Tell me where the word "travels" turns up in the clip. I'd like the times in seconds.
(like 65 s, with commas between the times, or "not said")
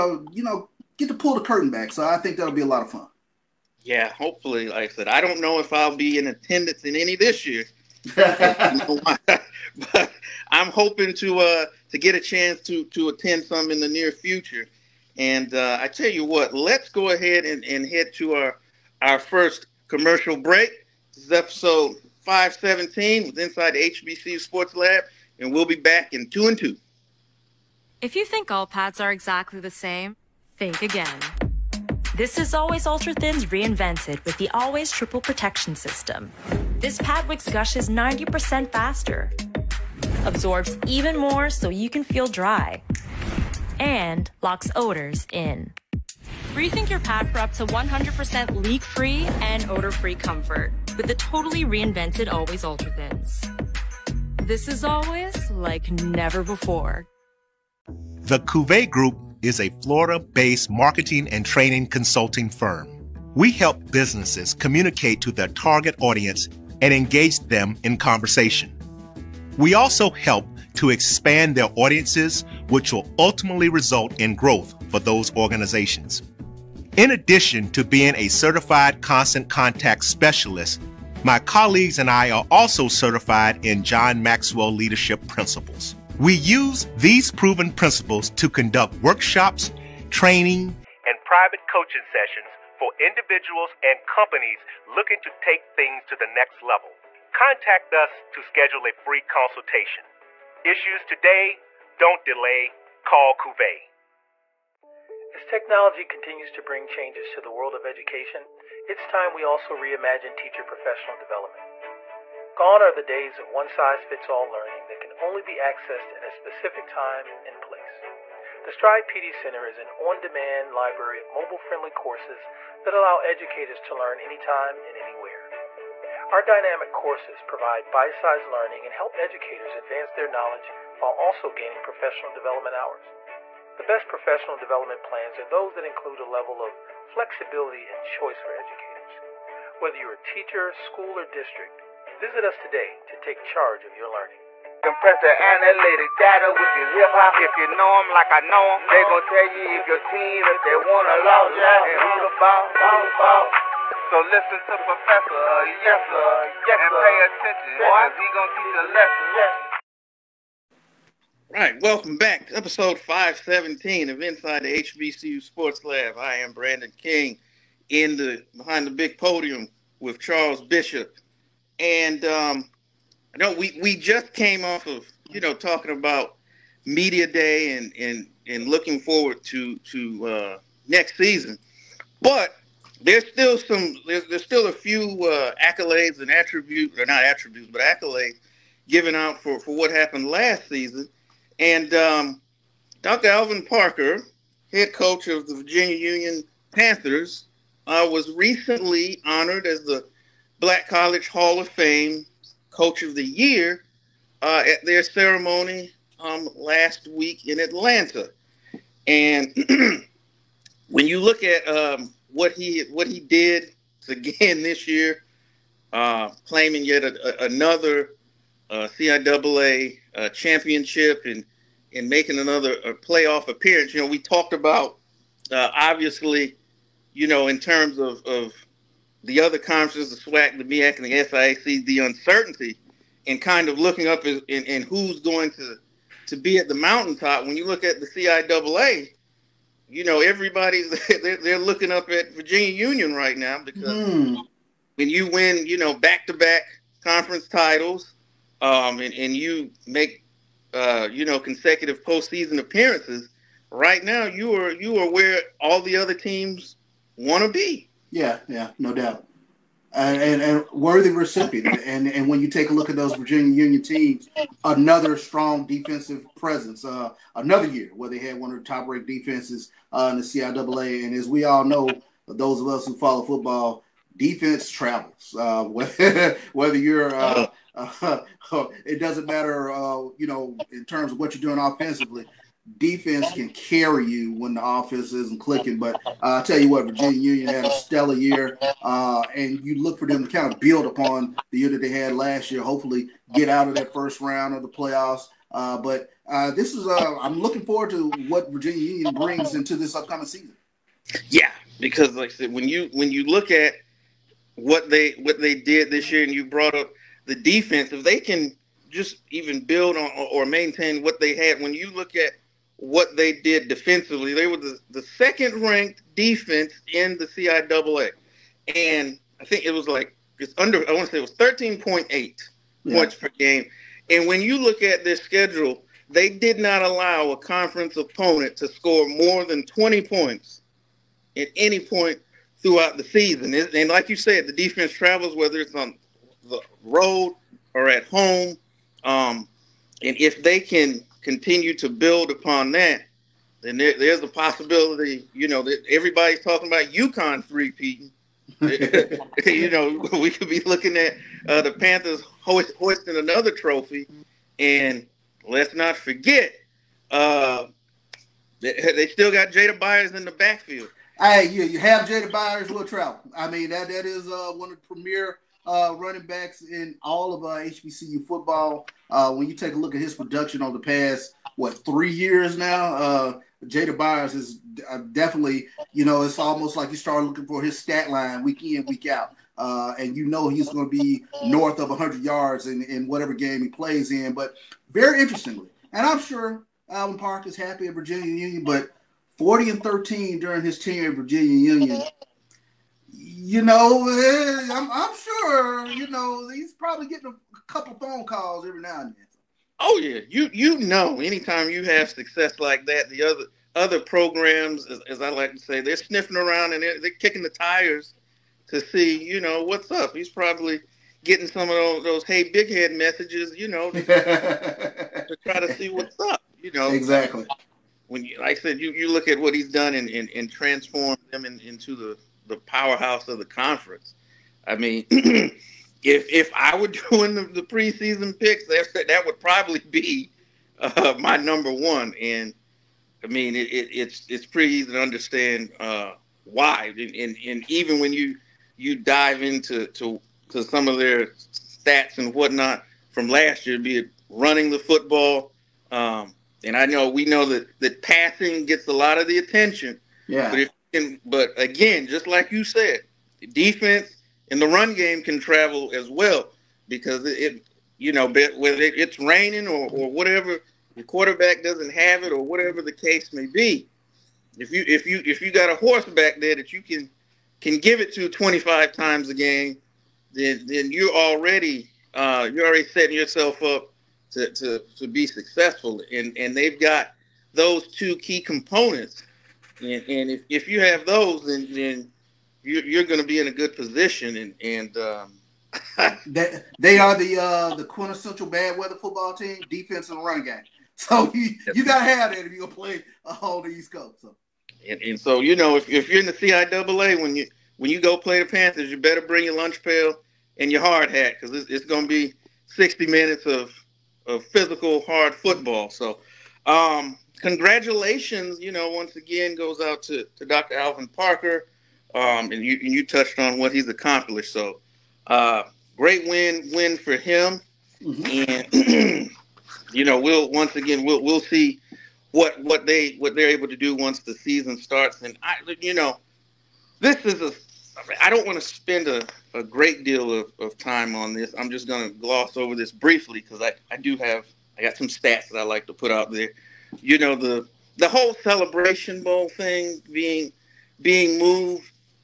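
274 s, 334 s, 455 s.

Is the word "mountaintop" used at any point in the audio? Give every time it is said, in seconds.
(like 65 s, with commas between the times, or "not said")
236 s.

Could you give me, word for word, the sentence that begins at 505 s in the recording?
So, um, congratulations, you know, once again goes out to, to Dr.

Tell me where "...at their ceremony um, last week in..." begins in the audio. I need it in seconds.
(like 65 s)
204 s.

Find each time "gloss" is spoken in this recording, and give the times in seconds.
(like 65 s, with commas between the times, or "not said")
532 s.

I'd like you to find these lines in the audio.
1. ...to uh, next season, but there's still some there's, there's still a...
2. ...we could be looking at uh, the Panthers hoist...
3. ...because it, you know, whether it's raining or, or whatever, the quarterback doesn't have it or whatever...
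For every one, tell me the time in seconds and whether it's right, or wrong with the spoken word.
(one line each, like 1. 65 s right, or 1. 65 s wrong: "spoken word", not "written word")
1. 179 s right
2. 350 s right
3. 456 s right.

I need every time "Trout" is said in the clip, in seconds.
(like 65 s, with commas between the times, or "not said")
362 s.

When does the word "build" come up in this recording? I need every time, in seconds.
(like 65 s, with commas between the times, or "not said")
290 s, 309 s, 341 s.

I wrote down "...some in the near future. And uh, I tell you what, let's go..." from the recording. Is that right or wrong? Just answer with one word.
right.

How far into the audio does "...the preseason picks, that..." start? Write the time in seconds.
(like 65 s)
427 s.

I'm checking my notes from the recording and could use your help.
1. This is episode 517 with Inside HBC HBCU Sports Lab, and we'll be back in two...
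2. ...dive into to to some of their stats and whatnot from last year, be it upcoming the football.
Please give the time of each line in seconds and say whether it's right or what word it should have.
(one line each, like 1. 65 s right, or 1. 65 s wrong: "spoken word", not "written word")
1. 21 s right
2. 438 s wrong: "running", not "upcoming".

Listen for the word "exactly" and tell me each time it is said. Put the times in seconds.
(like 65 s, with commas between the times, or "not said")
29 s, 416 s.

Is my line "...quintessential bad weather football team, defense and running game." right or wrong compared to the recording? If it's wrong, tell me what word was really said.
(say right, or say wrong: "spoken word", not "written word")
right.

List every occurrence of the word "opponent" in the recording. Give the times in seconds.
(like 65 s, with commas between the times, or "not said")
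327 s.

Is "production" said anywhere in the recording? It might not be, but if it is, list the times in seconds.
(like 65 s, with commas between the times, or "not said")
370 s.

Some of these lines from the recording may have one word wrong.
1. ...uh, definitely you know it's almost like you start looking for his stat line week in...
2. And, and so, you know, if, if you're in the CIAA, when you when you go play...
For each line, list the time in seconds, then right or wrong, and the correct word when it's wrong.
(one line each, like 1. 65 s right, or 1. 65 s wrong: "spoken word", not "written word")
1. 374 s right
2. 494 s right.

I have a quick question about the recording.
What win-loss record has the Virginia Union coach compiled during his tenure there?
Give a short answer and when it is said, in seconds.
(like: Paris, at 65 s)
40 and 13, at 389 s.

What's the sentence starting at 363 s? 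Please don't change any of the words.
I mean, that that is uh, one of the premier uh, running backs in all of uh, HBCU football.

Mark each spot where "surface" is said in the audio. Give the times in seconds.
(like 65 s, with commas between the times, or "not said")
not said.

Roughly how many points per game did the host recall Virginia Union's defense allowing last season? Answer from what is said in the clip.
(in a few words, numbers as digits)
13.8.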